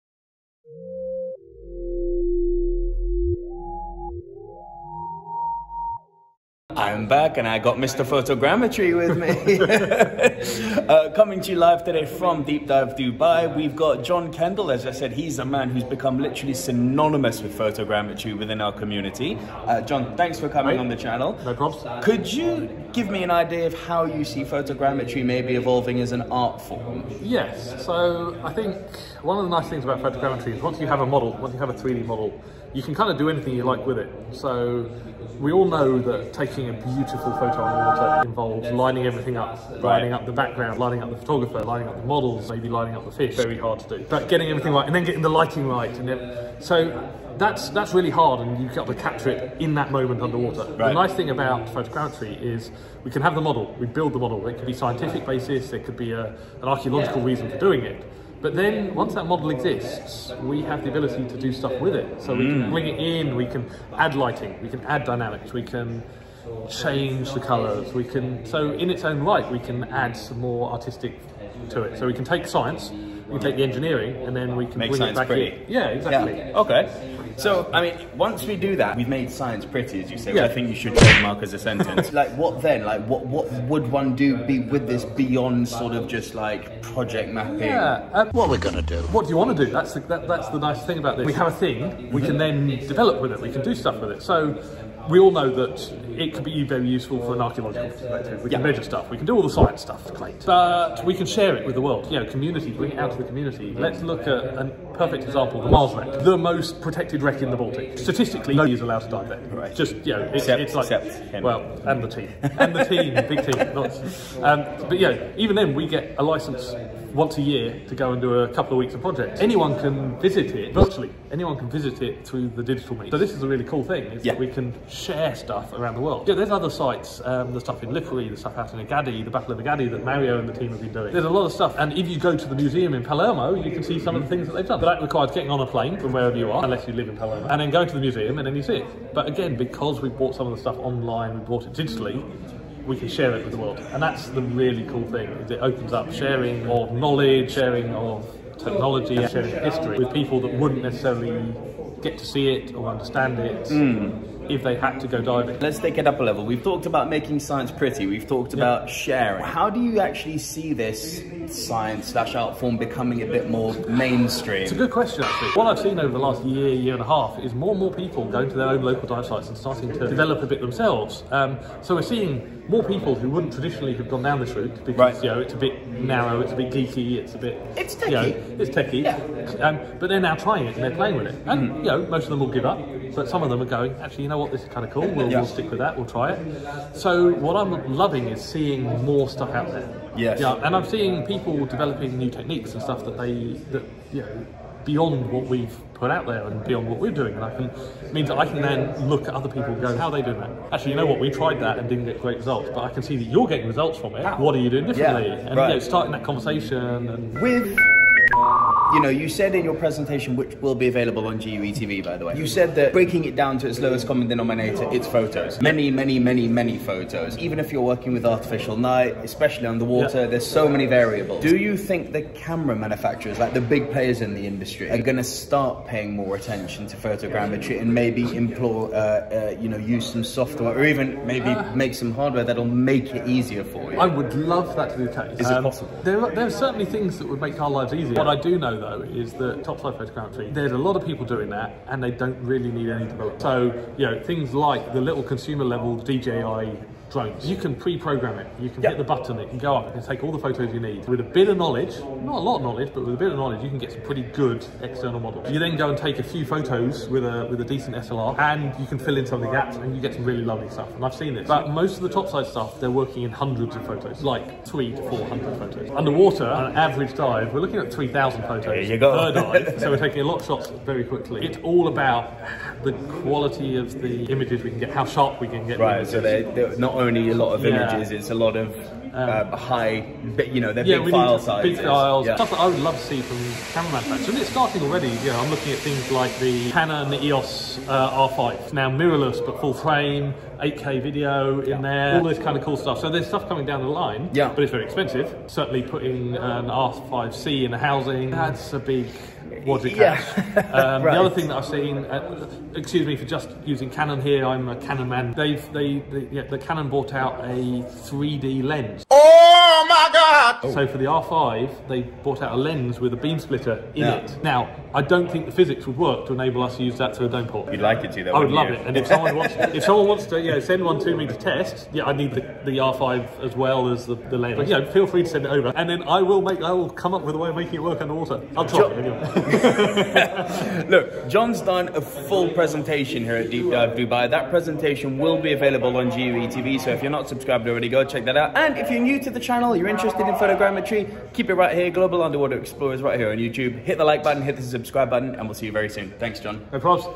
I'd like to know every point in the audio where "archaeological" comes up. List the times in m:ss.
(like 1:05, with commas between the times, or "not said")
0:56, 1:37.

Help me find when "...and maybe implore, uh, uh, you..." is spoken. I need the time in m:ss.
3:47.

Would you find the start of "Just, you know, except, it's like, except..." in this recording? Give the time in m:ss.
1:49.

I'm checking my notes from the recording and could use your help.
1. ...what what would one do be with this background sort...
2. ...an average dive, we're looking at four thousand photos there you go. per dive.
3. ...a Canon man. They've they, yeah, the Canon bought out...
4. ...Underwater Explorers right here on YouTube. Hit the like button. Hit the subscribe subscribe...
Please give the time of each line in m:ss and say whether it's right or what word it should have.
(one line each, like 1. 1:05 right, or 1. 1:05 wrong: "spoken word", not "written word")
1. 1:23 wrong: "beyond", not "background"
2. 4:26 wrong: "three", not "four"
3. 5:04 right
4. 5:42 right.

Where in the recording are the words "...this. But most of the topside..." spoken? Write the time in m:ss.
4:21.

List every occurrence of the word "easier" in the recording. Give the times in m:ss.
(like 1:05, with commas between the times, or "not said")
3:53, 3:57.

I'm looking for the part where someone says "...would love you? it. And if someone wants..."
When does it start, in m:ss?
5:18.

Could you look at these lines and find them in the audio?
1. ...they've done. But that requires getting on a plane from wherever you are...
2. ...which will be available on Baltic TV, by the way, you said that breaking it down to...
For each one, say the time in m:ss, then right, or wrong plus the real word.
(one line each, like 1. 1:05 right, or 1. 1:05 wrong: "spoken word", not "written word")
1. 2:14 right
2. 3:30 wrong: "GUE", not "Baltic".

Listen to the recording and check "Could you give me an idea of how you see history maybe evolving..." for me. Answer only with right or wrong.
wrong.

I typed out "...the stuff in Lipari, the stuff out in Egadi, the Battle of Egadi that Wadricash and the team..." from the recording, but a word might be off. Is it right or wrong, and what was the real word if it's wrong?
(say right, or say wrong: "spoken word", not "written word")
wrong: "Mario", not "Wadricash".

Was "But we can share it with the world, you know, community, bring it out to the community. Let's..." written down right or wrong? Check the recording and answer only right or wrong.
right.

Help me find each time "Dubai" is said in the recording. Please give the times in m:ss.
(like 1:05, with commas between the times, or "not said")
0:12, 5:33.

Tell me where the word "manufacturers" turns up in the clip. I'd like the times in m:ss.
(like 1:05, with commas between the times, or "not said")
3:42, 4:43.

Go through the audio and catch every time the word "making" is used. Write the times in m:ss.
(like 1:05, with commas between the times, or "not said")
2:37, 5:27.